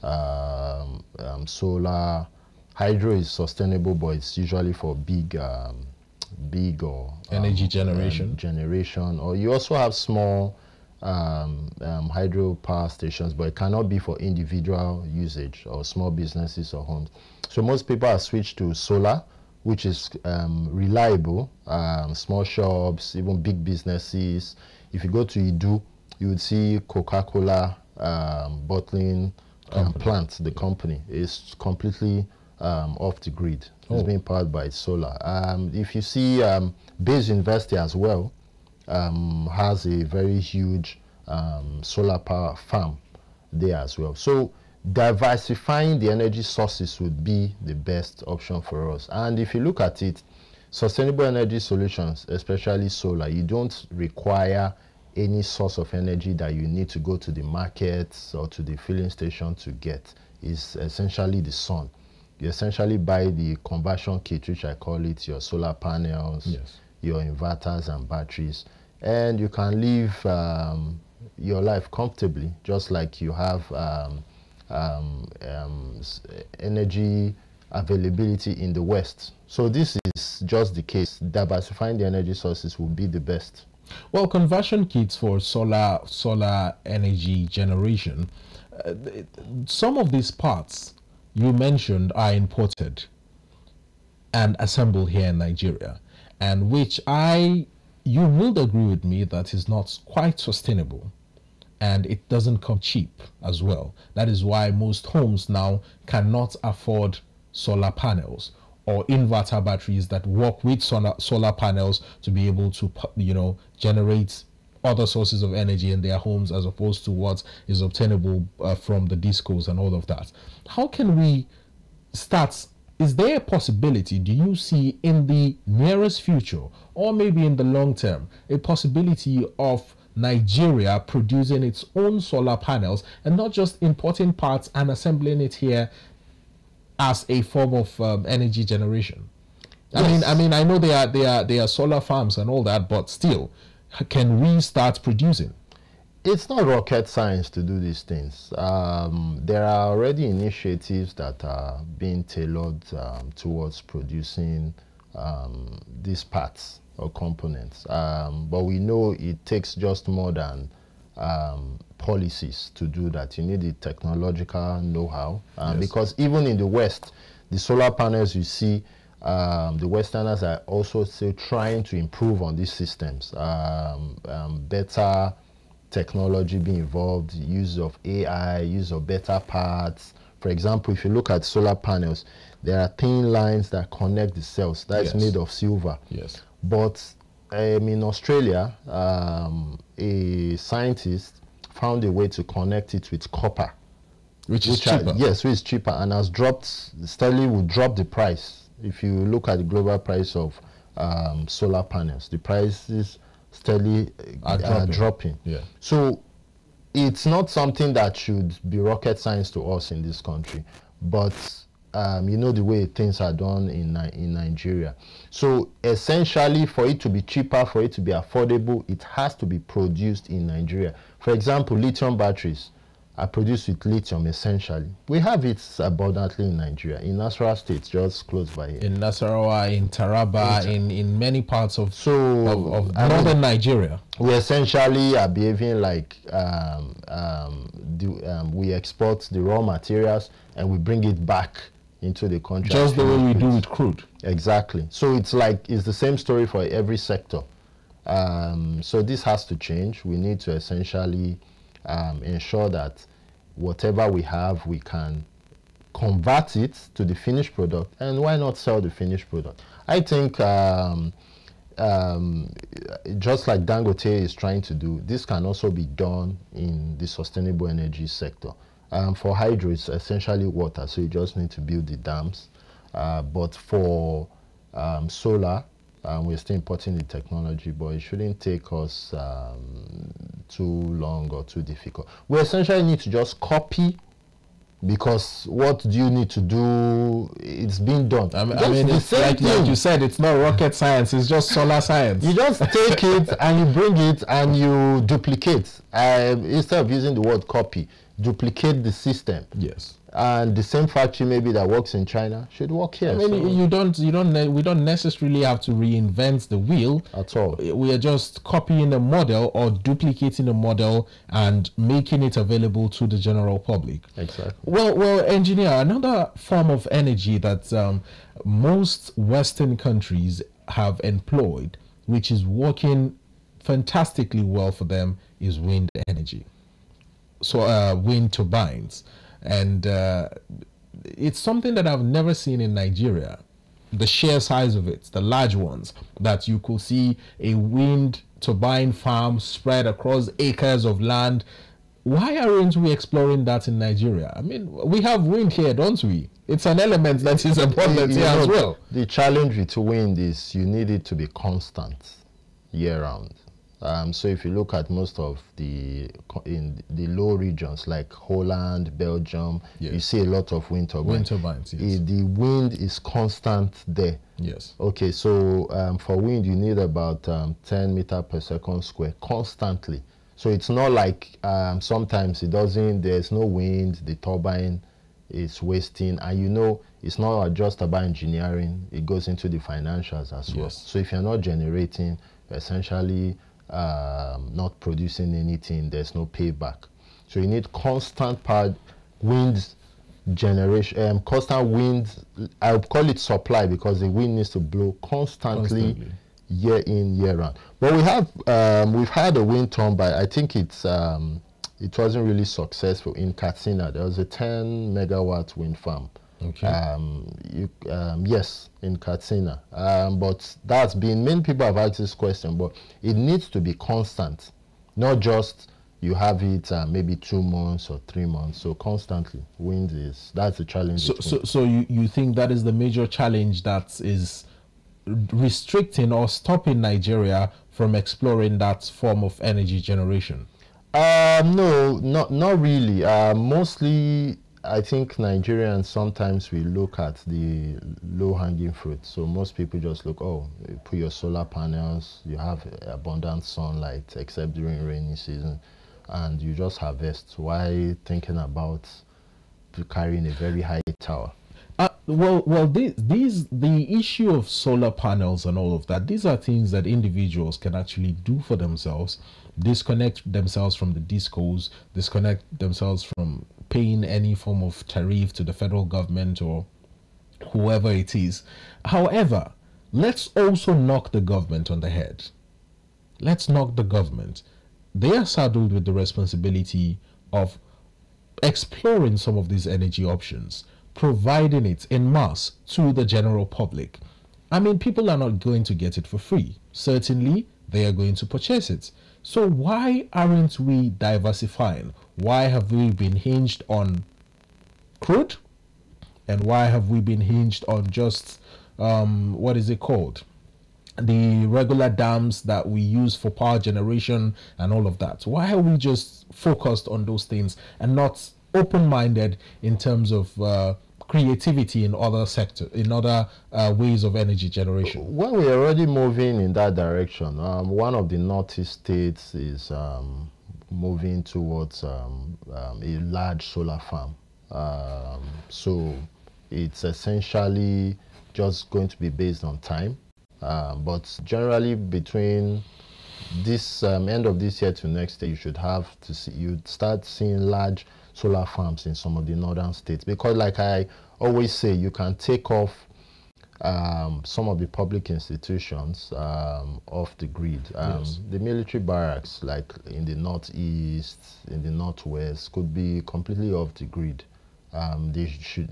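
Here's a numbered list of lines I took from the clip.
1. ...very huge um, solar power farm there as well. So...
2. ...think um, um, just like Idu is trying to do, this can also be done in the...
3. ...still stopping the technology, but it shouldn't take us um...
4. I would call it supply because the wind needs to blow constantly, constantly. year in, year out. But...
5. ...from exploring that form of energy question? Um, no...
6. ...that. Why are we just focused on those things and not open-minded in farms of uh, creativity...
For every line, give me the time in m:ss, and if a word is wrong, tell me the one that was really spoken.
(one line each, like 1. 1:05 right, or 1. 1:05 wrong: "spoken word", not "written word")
1. 0:40 right
2. 4:20 wrong: "Dangote", not "Idu"
3. 4:36 wrong: "importing", not "stopping"
4. 6:32 right
5. 7:07 wrong: "generation", not "question"
6. 8:24 wrong: "terms", not "farms".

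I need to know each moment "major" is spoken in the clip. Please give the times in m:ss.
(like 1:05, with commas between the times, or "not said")
7:02.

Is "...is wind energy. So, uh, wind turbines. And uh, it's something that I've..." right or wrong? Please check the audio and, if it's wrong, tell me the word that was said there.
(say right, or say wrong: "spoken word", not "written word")
right.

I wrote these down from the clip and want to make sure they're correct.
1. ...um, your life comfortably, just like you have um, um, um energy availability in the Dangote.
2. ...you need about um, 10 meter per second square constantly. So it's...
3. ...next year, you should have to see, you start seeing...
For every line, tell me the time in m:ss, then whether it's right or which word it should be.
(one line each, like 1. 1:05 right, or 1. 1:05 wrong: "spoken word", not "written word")
1. 1:10 wrong: "West", not "Dangote"
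2. 6:06 right
3. 8:54 right.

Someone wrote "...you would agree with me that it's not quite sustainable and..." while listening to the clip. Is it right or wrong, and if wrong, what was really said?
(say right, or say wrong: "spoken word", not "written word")
right.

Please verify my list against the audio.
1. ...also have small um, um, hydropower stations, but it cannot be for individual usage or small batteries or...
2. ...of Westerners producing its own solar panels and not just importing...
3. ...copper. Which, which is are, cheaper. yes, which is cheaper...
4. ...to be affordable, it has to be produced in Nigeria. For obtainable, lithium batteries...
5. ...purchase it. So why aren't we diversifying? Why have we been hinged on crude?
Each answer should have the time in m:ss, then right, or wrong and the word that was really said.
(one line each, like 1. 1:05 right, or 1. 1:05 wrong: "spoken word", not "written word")
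1. 0:09 wrong: "businesses", not "batteries"
2. 2:09 wrong: "Nigeria", not "Westerners"
3. 3:13 right
4. 3:37 wrong: "example", not "obtainable"
5. 8:08 right.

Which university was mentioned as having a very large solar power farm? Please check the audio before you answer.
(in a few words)
Baze University.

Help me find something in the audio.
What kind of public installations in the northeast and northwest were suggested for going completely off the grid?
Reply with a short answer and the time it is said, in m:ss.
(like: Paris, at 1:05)
military barracks, at 9:08.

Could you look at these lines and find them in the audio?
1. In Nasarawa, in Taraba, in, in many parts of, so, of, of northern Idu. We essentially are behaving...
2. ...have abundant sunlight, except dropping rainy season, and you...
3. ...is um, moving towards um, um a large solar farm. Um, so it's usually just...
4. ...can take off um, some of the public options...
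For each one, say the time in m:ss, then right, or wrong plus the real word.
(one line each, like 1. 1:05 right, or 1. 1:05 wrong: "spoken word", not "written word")
1. 3:48 wrong: "Nigeria", not "Idu"
2. 7:22 wrong: "during", not "dropping"
3. 8:39 wrong: "essentially", not "usually"
4. 9:01 wrong: "institutions", not "options".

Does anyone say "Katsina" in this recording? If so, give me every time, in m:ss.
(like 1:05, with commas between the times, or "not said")
6:43, 6:48.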